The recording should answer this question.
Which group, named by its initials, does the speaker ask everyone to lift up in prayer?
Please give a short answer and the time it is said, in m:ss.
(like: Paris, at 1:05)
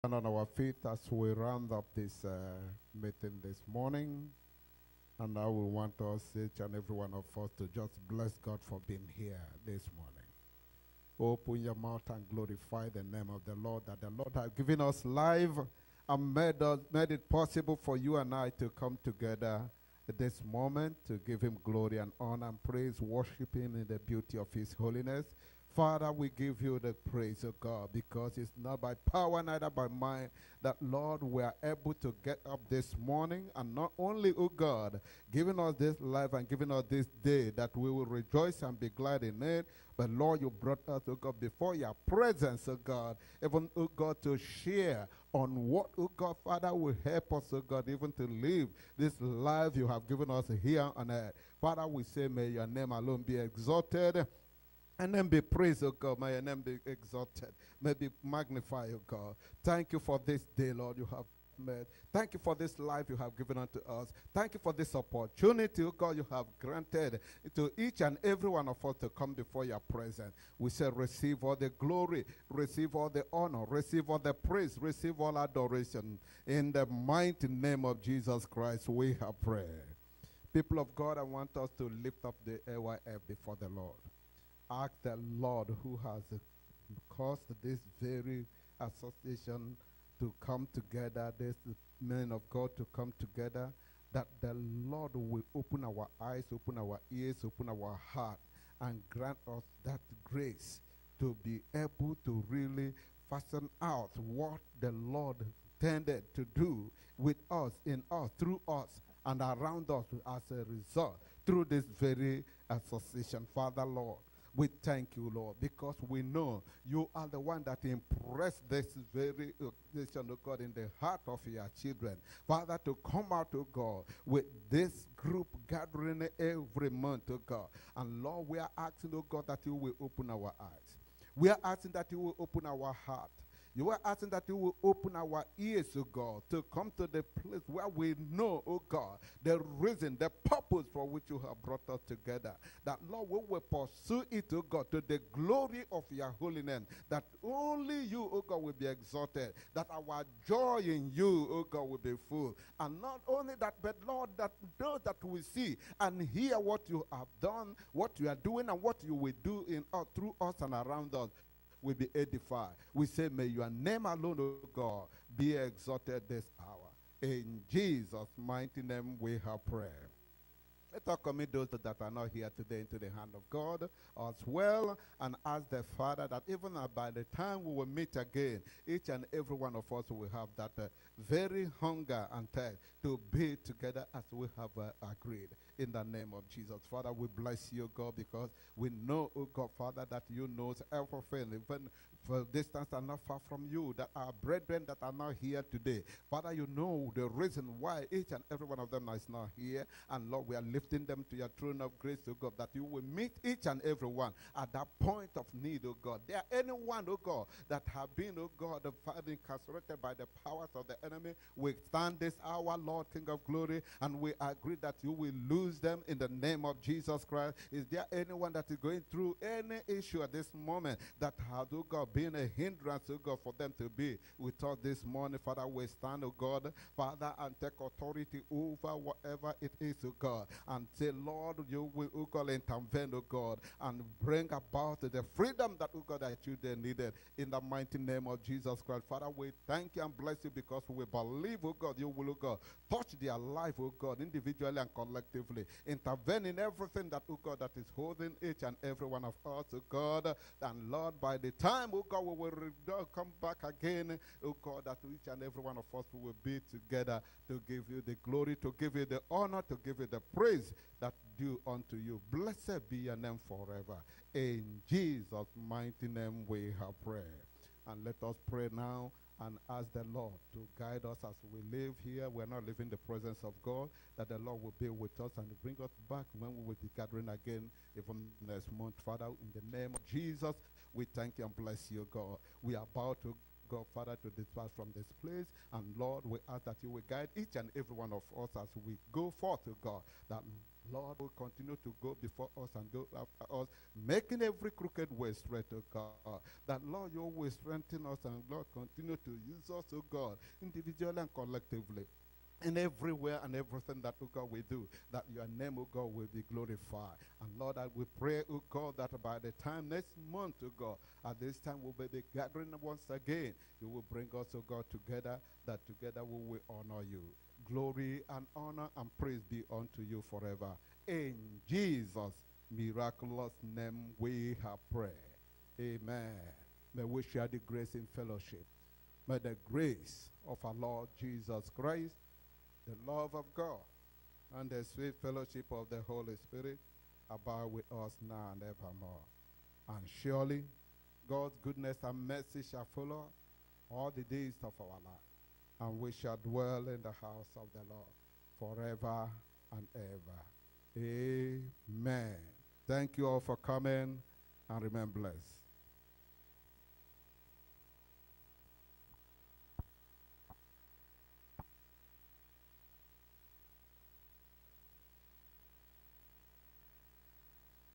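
AYF, at 1:22.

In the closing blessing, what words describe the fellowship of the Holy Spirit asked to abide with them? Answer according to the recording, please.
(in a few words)
sweet fellowship.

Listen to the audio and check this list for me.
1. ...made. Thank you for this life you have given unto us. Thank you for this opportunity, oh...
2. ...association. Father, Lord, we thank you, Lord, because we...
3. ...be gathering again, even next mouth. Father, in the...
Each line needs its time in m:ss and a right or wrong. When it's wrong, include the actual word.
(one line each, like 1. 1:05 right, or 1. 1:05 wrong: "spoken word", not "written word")
1. 1:01 right
2. 1:52 right
3. 4:36 wrong: "month", not "mouth".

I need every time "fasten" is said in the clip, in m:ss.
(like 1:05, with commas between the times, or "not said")
1:43.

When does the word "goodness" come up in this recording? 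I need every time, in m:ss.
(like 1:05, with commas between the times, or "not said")
5:41.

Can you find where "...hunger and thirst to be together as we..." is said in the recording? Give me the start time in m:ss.
3:01.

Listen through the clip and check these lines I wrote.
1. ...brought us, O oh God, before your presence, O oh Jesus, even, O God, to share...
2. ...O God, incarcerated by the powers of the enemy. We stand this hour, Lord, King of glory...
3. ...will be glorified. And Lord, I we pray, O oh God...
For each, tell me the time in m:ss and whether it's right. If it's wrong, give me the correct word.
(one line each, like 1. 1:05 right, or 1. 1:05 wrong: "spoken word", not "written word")
1. 0:40 wrong: "God", not "Jesus"
2. 3:28 right
3. 5:06 right.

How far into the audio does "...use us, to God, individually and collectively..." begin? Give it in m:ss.
4:59.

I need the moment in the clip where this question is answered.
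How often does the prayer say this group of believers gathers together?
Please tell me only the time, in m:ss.
2:06.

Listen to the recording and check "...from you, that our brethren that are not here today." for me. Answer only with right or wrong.
right.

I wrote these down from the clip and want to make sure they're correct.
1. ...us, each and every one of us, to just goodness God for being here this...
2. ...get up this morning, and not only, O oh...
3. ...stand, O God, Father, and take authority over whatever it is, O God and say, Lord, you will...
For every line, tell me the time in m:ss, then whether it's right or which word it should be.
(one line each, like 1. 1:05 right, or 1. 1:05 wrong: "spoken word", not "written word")
1. 0:06 wrong: "bless", not "goodness"
2. 0:32 right
3. 3:45 right.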